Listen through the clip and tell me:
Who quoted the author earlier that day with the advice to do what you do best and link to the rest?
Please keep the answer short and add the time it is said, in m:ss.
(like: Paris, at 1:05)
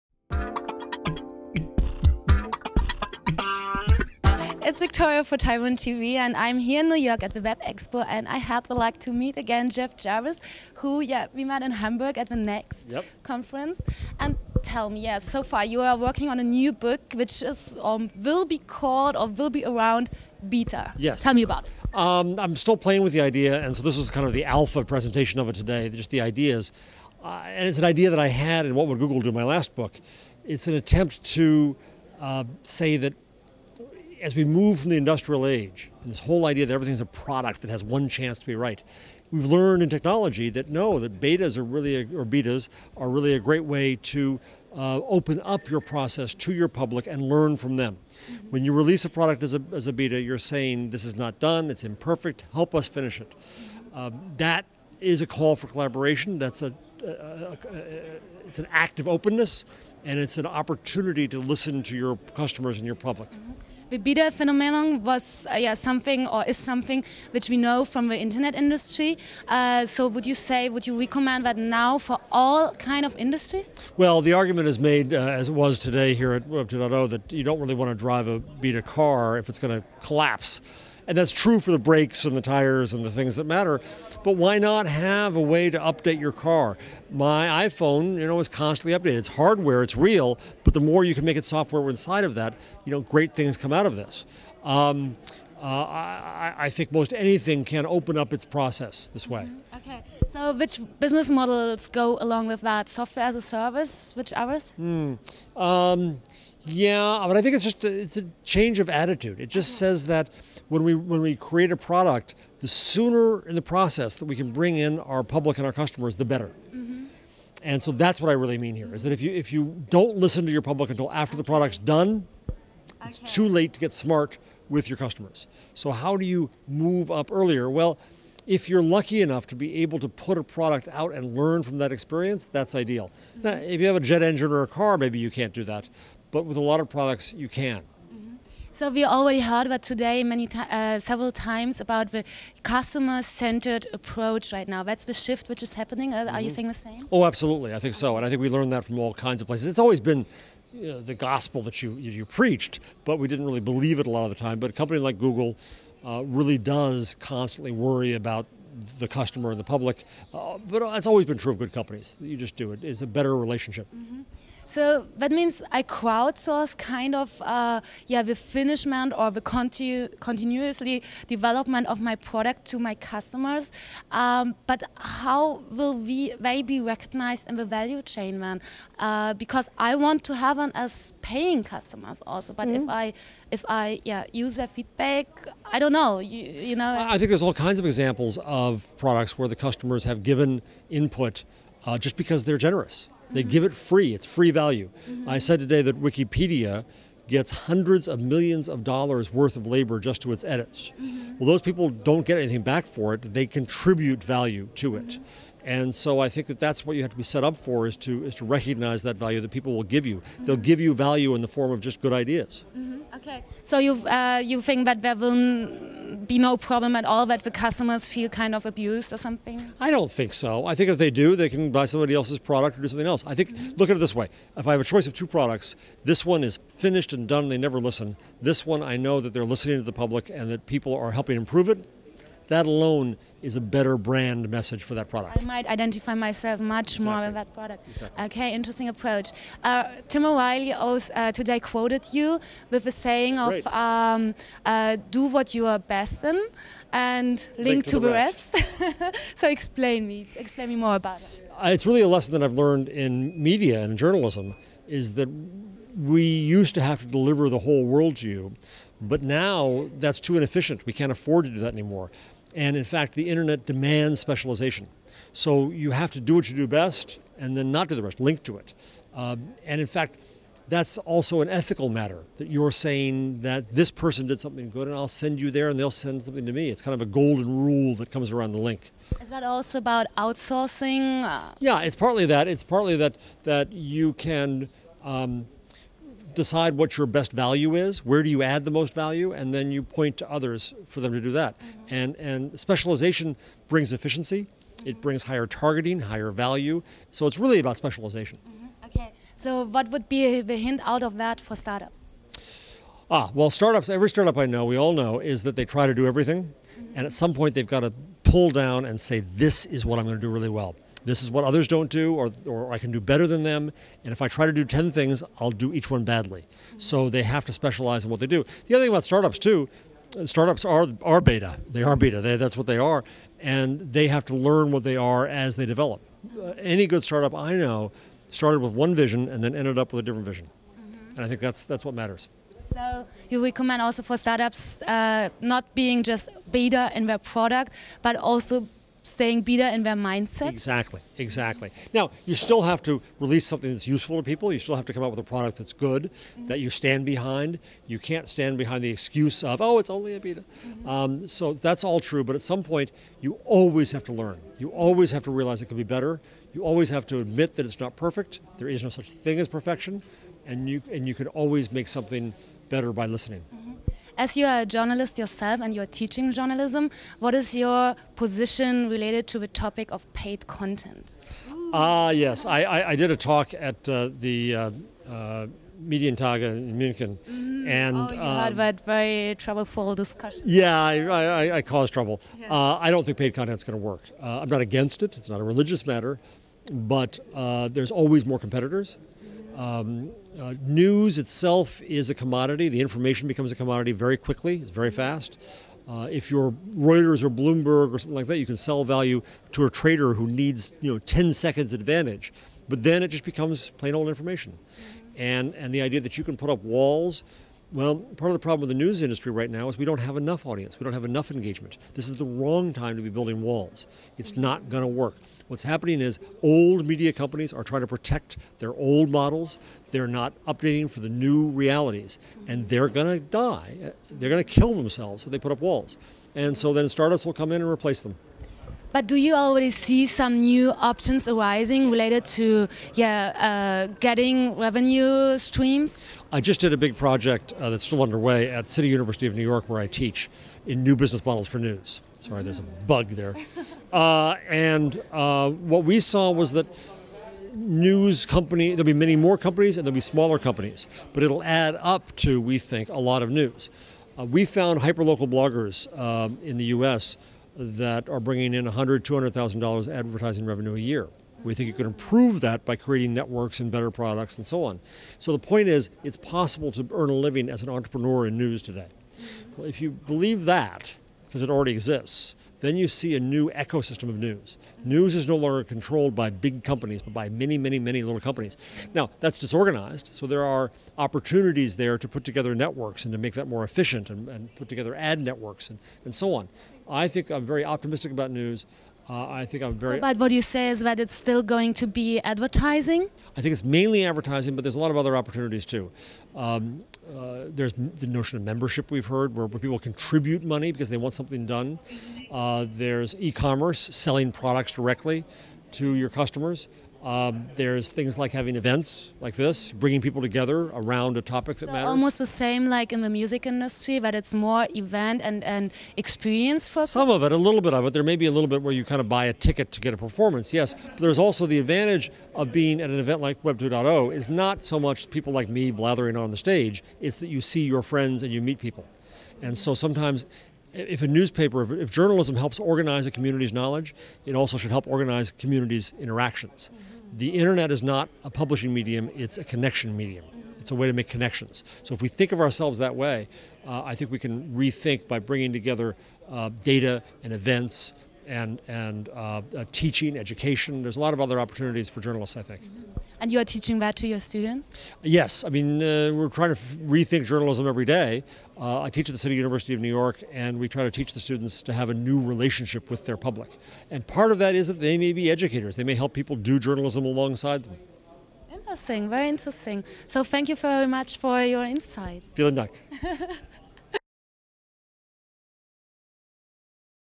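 Tim O'Reilly, at 4:00.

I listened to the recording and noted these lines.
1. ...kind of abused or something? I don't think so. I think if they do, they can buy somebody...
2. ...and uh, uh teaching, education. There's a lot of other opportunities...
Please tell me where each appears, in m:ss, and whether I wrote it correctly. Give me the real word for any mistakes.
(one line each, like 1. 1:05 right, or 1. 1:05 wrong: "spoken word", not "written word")
1. 3:38 right
2. 9:08 right.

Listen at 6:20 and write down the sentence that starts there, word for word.
Yeah, I, I, I caused trouble.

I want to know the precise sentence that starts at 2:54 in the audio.
Um, but how will we they be recognized in the value chain then?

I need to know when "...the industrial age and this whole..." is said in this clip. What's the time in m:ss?
0:34.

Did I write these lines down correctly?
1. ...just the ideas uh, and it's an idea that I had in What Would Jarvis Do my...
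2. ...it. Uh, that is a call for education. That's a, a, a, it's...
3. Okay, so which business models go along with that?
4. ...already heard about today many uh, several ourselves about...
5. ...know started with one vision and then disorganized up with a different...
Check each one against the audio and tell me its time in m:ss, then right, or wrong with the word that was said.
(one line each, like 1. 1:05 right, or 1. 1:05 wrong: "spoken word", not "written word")
1. 0:25 wrong: "Google", not "Jarvis"
2. 0:53 wrong: "collaboration", not "education"
3. 1:39 right
4. 2:19 wrong: "times", not "ourselves"
5. 5:27 wrong: "ended", not "disorganized".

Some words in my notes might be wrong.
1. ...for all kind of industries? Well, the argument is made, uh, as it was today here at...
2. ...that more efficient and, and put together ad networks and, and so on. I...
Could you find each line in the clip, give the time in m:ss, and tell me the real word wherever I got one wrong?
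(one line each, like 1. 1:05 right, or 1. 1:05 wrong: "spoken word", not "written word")
1. 1:11 right
2. 8:03 right.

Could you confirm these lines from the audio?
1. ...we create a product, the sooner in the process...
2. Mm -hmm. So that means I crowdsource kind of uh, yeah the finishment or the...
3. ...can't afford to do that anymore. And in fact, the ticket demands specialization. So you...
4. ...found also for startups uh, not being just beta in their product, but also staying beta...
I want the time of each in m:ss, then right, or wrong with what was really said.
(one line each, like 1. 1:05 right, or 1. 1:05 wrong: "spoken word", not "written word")
1. 1:51 right
2. 2:43 right
3. 4:20 wrong: "internet", not "ticket"
4. 5:33 wrong: "recommend", not "found".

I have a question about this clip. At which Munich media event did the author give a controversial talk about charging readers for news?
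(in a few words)
Medientage.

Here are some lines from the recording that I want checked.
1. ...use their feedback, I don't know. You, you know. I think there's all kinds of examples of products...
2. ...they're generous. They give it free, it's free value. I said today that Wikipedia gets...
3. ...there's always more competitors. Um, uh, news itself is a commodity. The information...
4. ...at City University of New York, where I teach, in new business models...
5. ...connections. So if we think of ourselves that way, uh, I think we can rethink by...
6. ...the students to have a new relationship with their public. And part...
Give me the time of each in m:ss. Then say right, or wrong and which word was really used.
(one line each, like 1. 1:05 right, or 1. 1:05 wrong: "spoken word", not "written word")
1. 3:04 right
2. 3:12 right
3. 6:27 right
4. 7:18 right
5. 9:01 right
6. 9:21 right.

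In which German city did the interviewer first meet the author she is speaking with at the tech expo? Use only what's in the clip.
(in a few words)
Hamburg.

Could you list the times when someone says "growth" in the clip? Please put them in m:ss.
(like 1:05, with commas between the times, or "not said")
not said.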